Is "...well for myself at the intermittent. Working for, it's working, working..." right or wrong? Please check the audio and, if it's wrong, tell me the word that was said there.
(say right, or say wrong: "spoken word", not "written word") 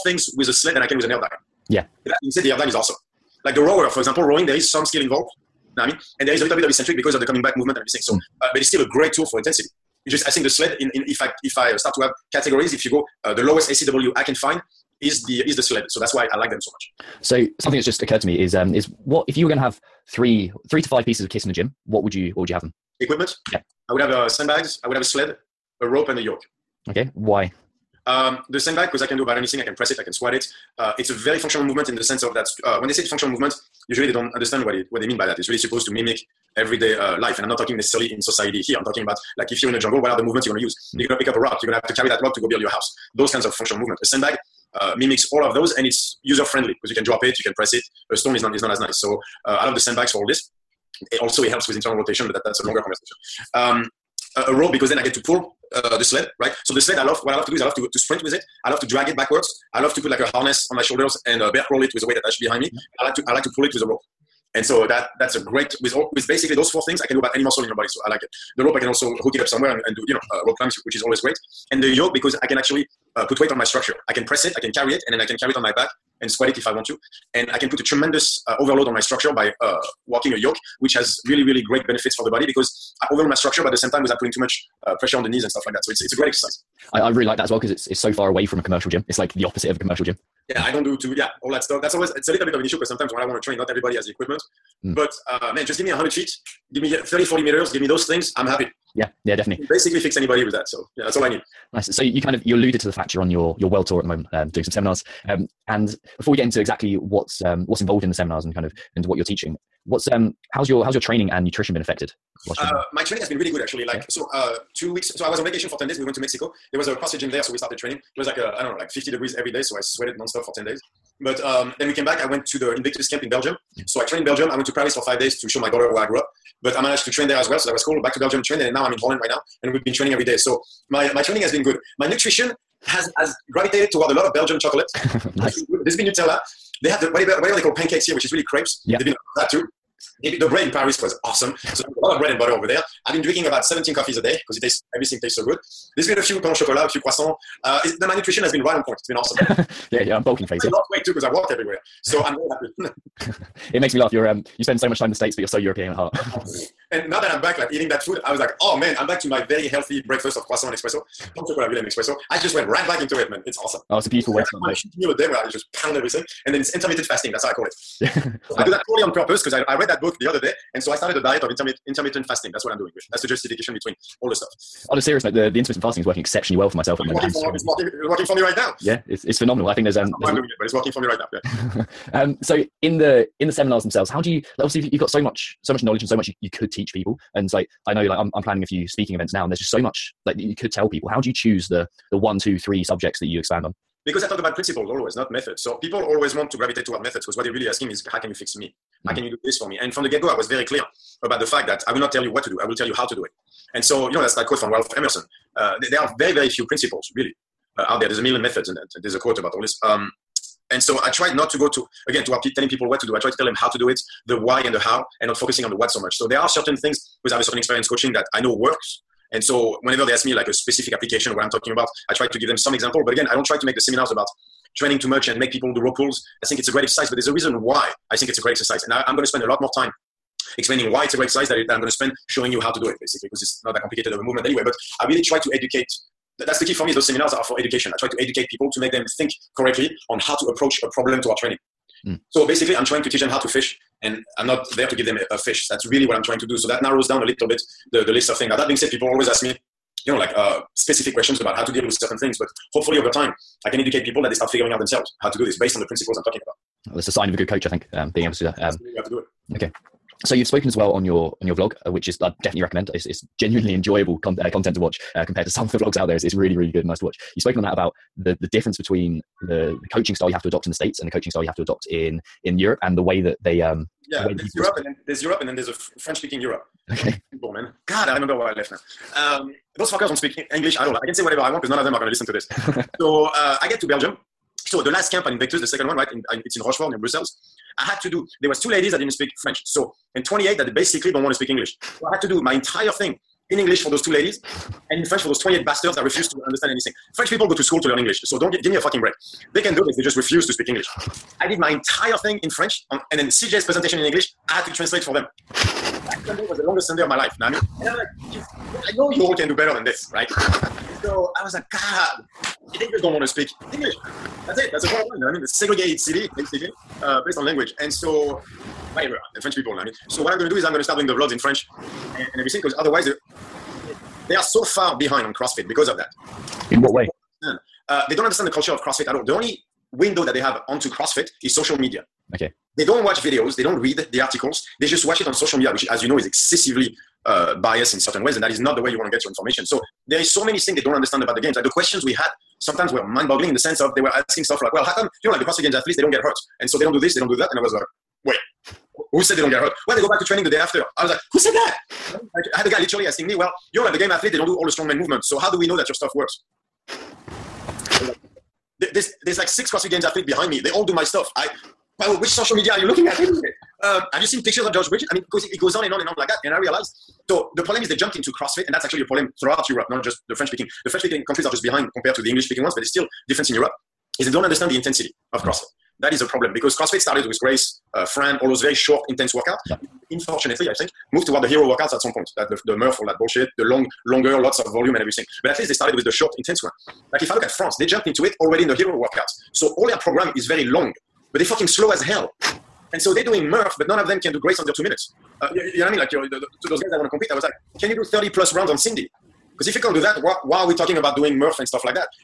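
wrong: "moment", not "intermittent".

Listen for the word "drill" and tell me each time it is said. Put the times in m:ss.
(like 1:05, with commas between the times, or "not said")
not said.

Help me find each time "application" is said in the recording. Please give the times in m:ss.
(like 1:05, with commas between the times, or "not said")
3:40.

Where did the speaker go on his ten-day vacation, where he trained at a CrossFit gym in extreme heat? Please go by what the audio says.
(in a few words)
Mexico.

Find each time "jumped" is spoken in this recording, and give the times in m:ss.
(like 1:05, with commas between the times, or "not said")
6:07, 6:27.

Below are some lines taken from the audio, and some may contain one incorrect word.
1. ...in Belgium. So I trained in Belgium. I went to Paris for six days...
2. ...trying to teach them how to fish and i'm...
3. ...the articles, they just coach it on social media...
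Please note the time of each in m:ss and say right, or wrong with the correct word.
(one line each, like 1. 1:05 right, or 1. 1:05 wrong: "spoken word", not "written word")
1. 2:03 wrong: "five", not "six"
2. 4:02 right
3. 5:34 wrong: "watch", not "coach".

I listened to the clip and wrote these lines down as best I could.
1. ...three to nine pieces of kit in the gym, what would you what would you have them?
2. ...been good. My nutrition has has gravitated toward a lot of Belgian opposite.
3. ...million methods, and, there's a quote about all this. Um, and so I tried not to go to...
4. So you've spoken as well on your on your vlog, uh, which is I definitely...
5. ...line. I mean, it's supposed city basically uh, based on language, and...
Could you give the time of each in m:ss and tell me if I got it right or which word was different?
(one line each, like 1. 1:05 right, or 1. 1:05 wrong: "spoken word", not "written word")
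1. 0:20 wrong: "five", not "nine"
2. 2:11 wrong: "chocolate", not "opposite"
3. 3:28 right
4. 4:20 right
5. 5:15 wrong: "segregated", not "supposed".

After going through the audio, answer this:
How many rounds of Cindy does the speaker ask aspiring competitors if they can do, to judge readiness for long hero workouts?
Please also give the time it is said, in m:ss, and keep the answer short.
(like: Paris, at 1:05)
30+, at 6:38.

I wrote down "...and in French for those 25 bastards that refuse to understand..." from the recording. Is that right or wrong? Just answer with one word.
wrong.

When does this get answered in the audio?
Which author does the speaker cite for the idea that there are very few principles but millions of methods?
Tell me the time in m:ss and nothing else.
3:24.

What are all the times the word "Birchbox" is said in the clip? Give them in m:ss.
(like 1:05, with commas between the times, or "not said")
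not said.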